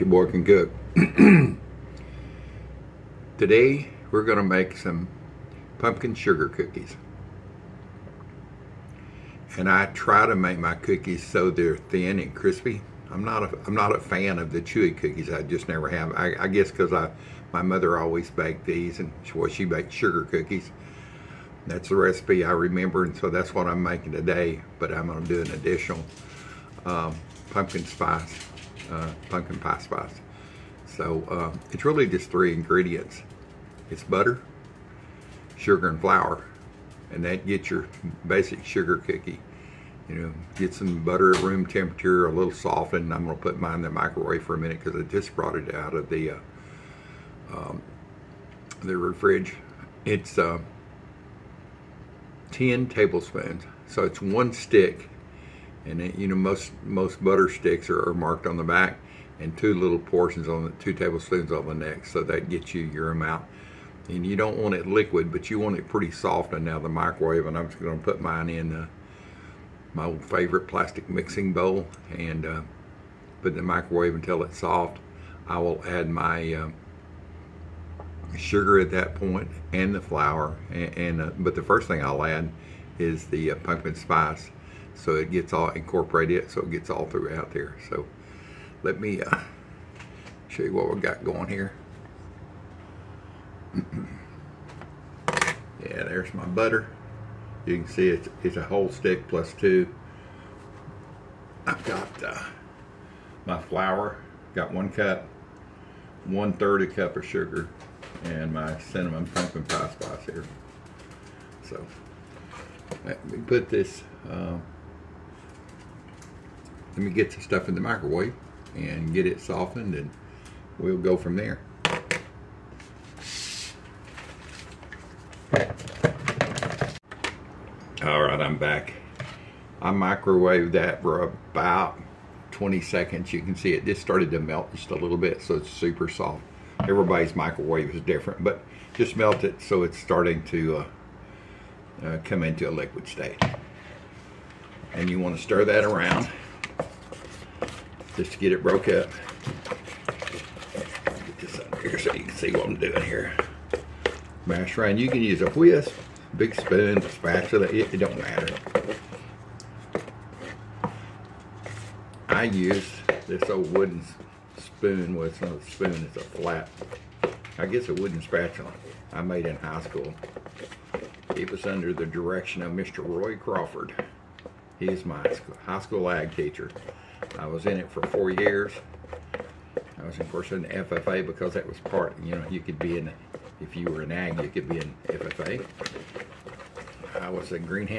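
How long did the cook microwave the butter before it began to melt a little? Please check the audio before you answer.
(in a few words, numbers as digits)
20 seconds.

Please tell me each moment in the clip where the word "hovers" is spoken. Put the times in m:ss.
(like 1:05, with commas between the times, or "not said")
not said.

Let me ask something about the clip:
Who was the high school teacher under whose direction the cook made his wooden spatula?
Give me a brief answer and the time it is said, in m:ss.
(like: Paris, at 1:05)
Roy Crawford, at 2:52.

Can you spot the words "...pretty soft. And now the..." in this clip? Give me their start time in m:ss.
1:05.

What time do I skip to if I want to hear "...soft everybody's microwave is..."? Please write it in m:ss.
2:16.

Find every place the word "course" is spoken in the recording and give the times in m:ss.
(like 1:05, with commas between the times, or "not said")
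3:00.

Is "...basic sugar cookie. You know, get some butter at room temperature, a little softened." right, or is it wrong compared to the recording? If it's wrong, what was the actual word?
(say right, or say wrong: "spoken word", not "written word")
right.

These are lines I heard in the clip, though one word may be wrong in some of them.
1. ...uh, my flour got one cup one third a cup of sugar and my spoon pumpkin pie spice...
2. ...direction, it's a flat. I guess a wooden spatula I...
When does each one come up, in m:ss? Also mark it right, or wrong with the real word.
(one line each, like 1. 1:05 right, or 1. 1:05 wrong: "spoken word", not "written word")
1. 1:42 wrong: "cinnamon", not "spoon"
2. 2:45 wrong: "spoon", not "direction".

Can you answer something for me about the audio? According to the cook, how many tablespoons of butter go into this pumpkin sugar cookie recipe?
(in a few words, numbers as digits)
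10.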